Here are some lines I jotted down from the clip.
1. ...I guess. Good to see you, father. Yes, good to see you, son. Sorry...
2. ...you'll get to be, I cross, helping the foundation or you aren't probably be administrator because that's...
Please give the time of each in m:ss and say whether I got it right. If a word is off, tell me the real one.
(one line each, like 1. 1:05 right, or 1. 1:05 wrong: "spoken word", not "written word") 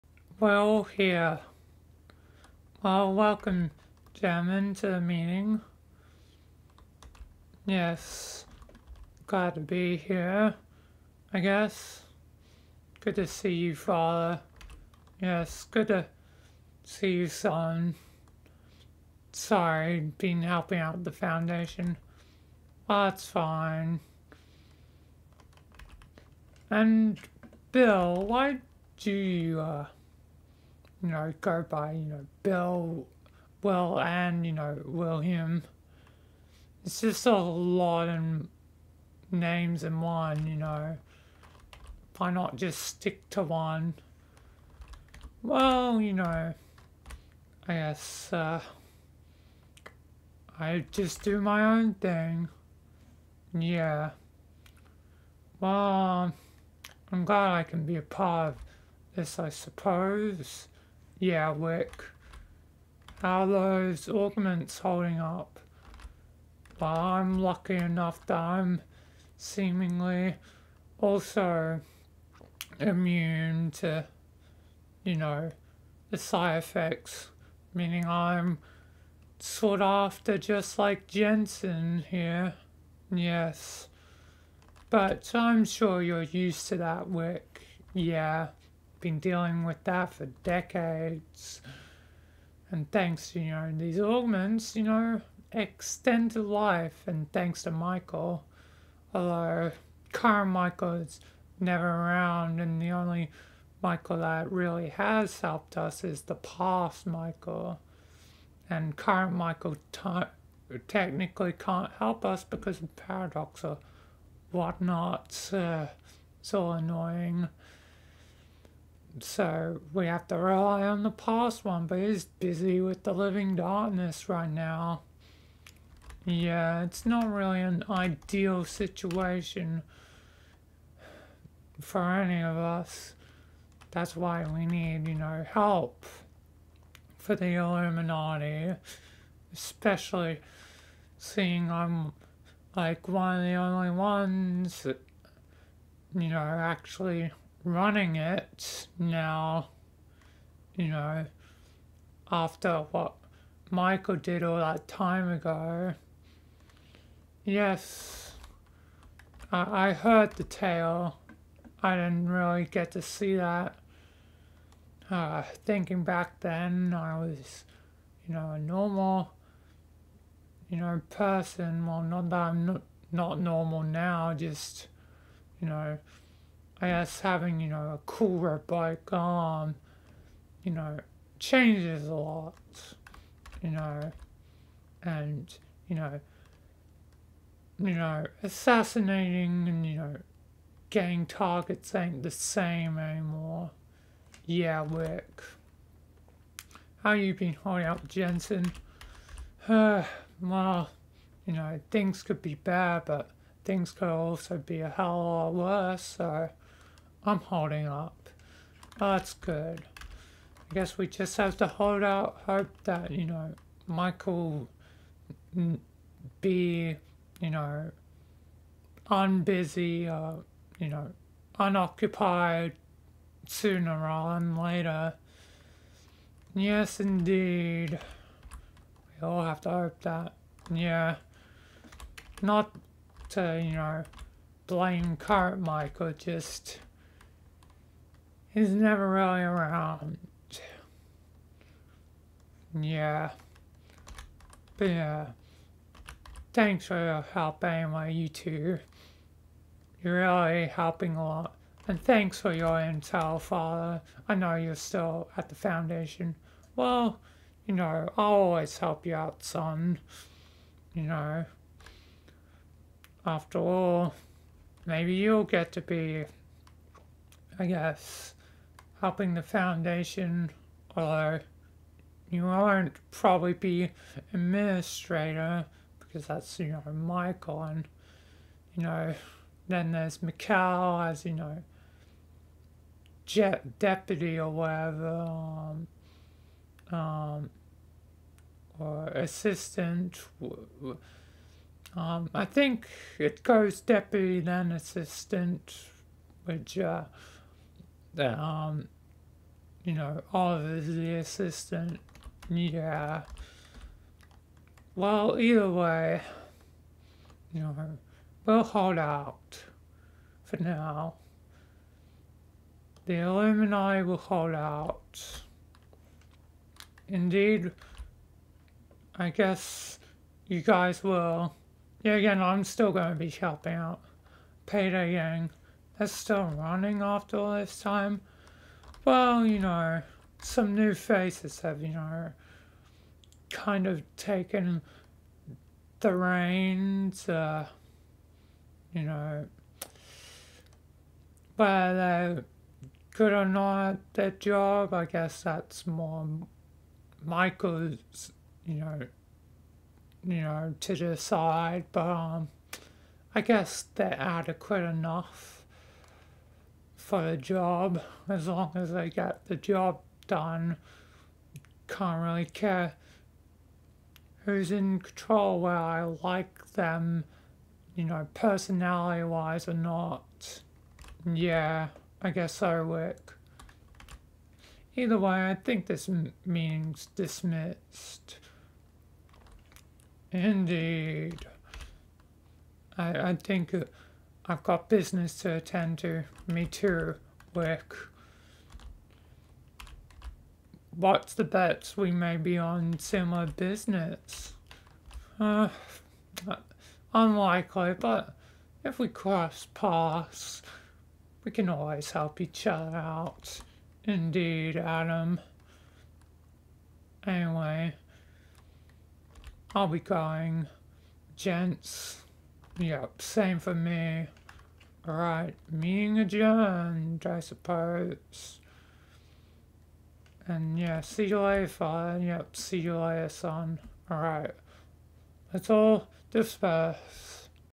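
1. 0:11 right
2. 4:25 wrong: "guess", not "cross".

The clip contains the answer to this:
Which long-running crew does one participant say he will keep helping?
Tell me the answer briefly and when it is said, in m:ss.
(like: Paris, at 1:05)
Payday gang, at 5:24.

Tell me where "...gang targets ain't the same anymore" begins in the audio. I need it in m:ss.
3:10.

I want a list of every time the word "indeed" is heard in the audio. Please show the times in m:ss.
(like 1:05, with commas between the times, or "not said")
3:46, 5:17, 6:20, 6:44.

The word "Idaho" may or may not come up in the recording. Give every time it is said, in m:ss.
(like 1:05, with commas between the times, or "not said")
not said.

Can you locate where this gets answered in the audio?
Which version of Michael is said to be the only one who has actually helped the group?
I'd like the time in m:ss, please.
1:46.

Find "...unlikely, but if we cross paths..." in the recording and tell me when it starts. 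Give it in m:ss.
6:37.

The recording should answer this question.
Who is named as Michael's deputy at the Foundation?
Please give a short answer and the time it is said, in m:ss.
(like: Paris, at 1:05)
Mikhail, at 4:40.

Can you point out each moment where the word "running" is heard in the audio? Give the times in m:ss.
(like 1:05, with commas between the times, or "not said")
2:27, 5:26.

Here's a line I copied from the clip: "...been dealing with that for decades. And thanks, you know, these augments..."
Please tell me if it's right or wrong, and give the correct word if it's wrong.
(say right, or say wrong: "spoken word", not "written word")
right.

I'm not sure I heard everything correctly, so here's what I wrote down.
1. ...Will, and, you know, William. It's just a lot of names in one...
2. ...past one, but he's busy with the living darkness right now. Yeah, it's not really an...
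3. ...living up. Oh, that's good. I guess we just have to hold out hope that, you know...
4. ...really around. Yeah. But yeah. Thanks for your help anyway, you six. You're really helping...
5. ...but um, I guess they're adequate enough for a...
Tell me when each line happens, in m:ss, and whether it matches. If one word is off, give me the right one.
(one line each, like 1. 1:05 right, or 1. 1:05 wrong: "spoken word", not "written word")
1. 0:33 right
2. 2:01 right
3. 3:27 wrong: "holding", not "living"
4. 3:59 wrong: "two", not "six"
5. 5:51 right.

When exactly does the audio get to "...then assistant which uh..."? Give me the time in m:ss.
4:54.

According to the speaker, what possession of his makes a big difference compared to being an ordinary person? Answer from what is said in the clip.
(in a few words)
A cooler bike.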